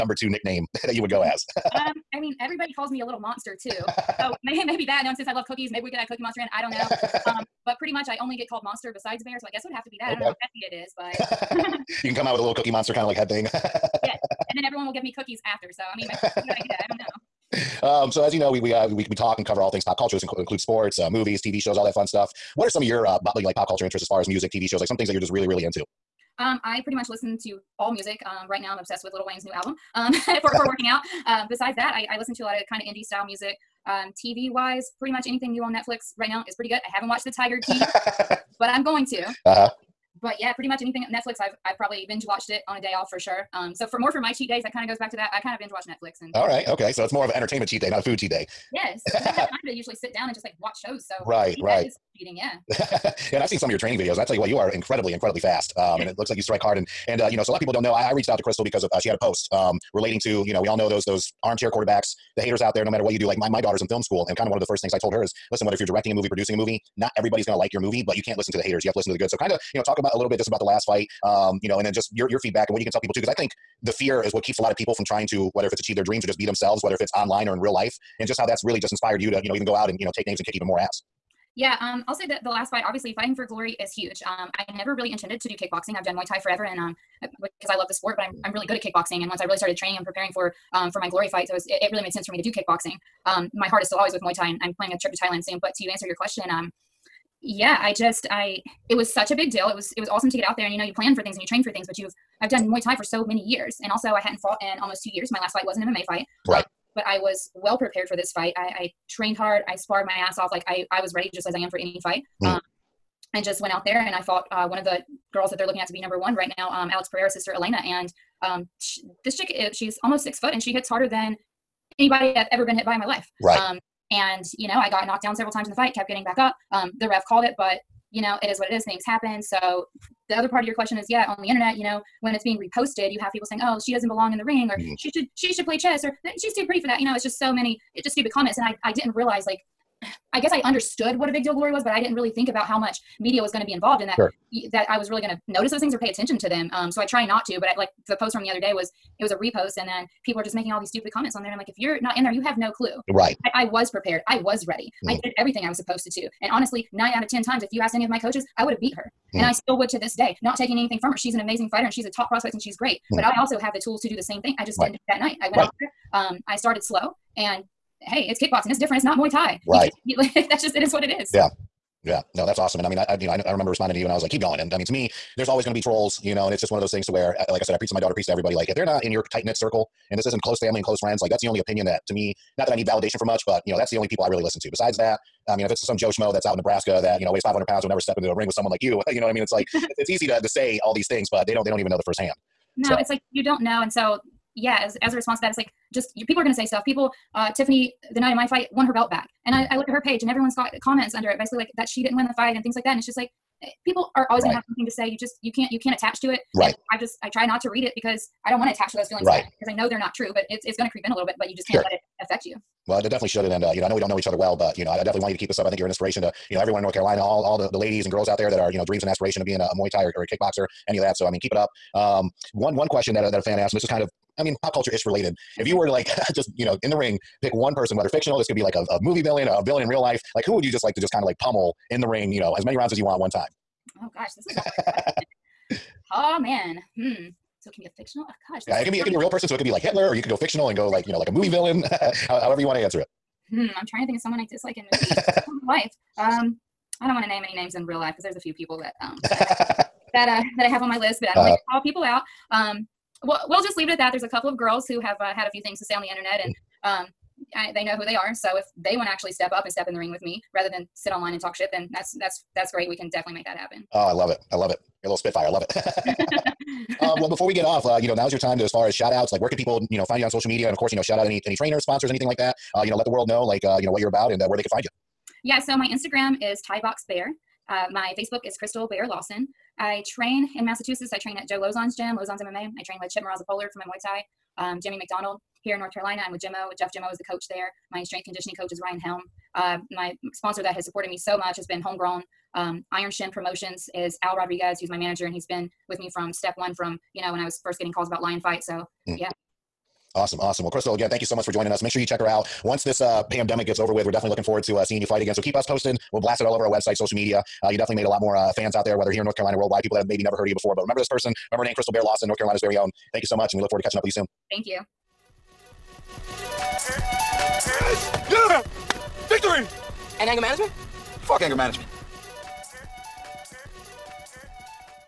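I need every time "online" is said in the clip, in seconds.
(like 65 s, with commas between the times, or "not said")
77 s, 261 s.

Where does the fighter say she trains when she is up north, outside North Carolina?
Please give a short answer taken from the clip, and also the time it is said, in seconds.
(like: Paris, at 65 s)
Massachusetts, at 280 s.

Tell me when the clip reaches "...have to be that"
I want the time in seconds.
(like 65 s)
9 s.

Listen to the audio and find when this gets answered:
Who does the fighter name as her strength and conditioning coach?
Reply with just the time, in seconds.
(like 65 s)
288 s.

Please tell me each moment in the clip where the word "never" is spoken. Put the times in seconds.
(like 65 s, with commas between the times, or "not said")
84 s, 187 s, 310 s.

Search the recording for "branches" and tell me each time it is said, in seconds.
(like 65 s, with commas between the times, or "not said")
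not said.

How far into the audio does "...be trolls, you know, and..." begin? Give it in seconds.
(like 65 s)
175 s.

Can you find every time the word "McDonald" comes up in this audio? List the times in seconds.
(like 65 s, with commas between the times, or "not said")
284 s.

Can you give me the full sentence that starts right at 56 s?
And and uh, you know, so a lot of people don't know.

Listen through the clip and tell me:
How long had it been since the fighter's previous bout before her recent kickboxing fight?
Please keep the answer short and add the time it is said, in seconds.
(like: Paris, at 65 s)
almost 2 years, at 104 s.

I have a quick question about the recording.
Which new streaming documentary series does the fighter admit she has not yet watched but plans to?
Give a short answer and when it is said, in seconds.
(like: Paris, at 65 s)
Tiger King, at 37 s.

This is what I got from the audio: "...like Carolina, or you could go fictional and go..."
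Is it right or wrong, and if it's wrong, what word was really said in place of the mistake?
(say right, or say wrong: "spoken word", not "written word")
wrong: "Hitler", not "Carolina".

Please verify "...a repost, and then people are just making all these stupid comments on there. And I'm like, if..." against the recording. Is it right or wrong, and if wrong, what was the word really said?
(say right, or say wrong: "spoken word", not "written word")
right.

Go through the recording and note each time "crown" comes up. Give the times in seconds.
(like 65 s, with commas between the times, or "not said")
not said.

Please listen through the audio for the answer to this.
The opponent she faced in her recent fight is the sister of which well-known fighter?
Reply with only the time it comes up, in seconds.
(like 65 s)
116 s.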